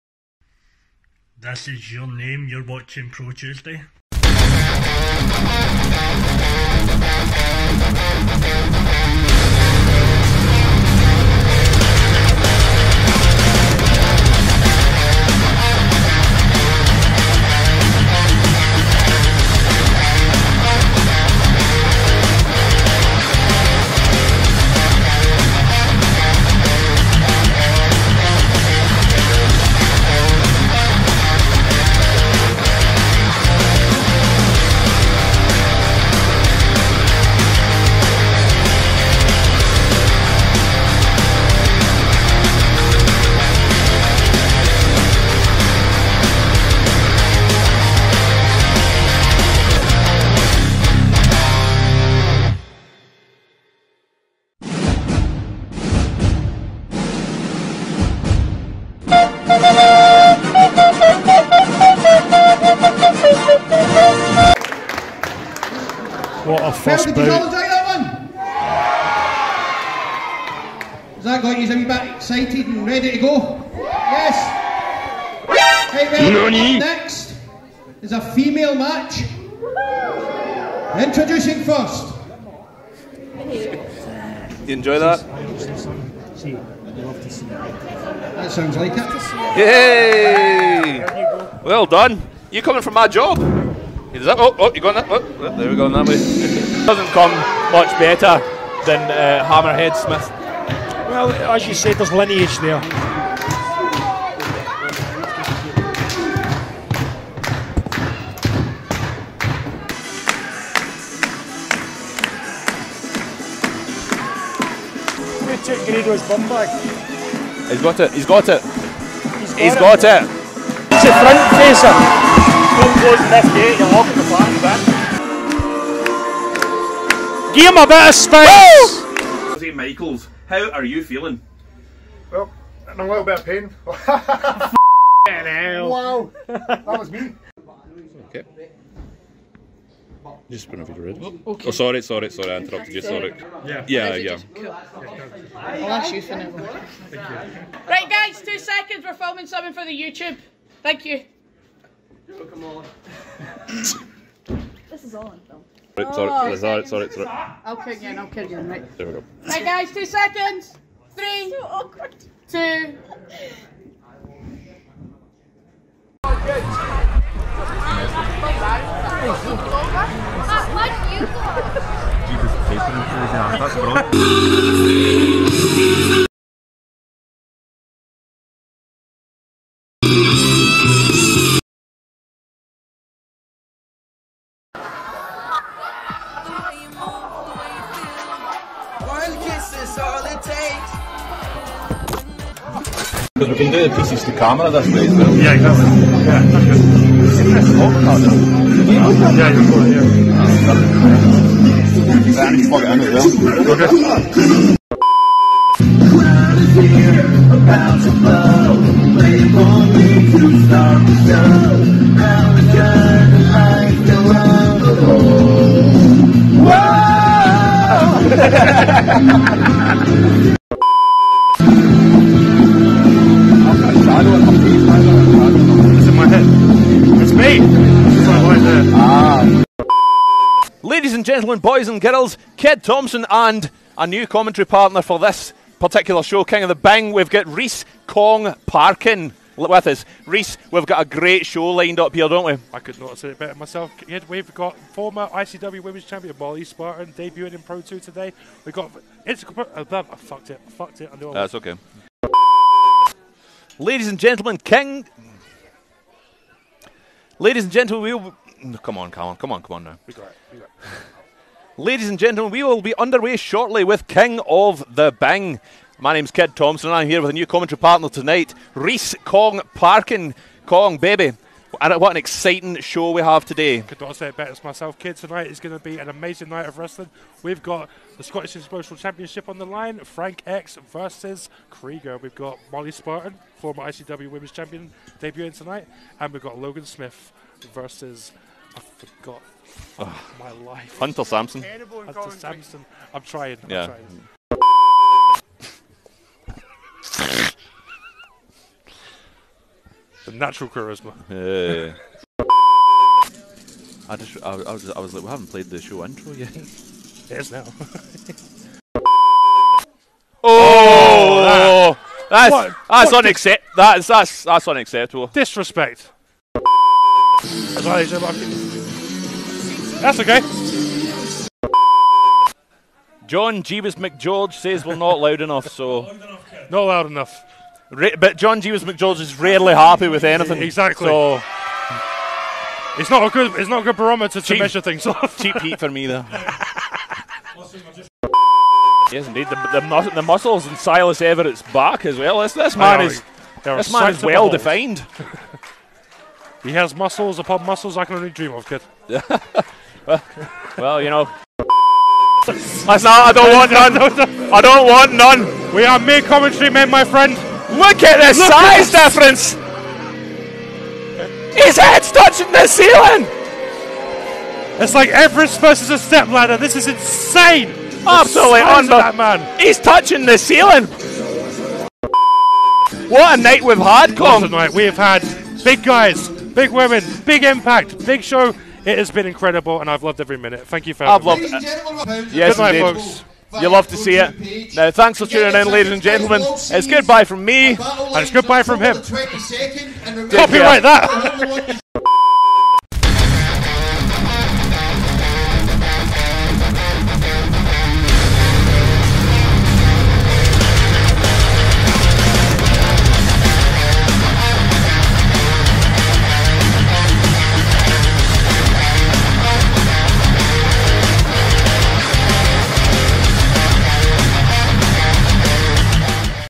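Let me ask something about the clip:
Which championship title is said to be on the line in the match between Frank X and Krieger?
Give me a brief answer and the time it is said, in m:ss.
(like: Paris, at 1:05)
Scottish Explosive Championship, at 4:38.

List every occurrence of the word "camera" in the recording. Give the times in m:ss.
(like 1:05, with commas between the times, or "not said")
3:14.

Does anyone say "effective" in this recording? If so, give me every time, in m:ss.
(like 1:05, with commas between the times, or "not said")
not said.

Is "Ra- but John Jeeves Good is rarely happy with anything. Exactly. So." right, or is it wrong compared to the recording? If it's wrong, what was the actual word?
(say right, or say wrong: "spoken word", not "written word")
wrong: "McGeorge", not "Good".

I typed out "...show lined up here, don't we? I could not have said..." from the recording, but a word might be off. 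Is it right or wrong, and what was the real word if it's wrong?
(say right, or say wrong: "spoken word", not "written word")
right.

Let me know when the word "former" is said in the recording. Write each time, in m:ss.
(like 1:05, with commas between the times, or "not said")
4:04, 4:43.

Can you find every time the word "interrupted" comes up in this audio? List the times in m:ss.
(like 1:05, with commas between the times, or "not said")
2:22.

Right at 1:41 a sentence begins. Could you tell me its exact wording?
Well, as you said, there's lineage there.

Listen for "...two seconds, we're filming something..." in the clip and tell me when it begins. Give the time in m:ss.
2:28.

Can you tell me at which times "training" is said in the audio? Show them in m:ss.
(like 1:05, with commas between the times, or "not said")
not said.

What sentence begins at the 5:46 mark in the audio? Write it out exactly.
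He has muscles upon muscles I can only dream of, kid.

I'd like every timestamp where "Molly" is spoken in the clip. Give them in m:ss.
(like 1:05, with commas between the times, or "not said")
4:06, 4:42.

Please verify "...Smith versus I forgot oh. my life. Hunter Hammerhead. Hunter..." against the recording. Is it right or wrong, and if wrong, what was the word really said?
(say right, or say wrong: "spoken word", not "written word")
wrong: "Sampson", not "Hammerhead".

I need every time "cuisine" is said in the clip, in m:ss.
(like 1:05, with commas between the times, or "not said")
not said.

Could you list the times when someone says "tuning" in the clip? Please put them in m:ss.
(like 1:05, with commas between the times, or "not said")
6:25.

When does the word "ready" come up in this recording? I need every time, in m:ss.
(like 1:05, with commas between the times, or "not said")
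1:12, 2:21.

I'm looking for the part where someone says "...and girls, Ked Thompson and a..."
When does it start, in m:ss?
3:51.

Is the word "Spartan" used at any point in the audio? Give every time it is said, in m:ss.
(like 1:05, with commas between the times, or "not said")
4:06, 4:42.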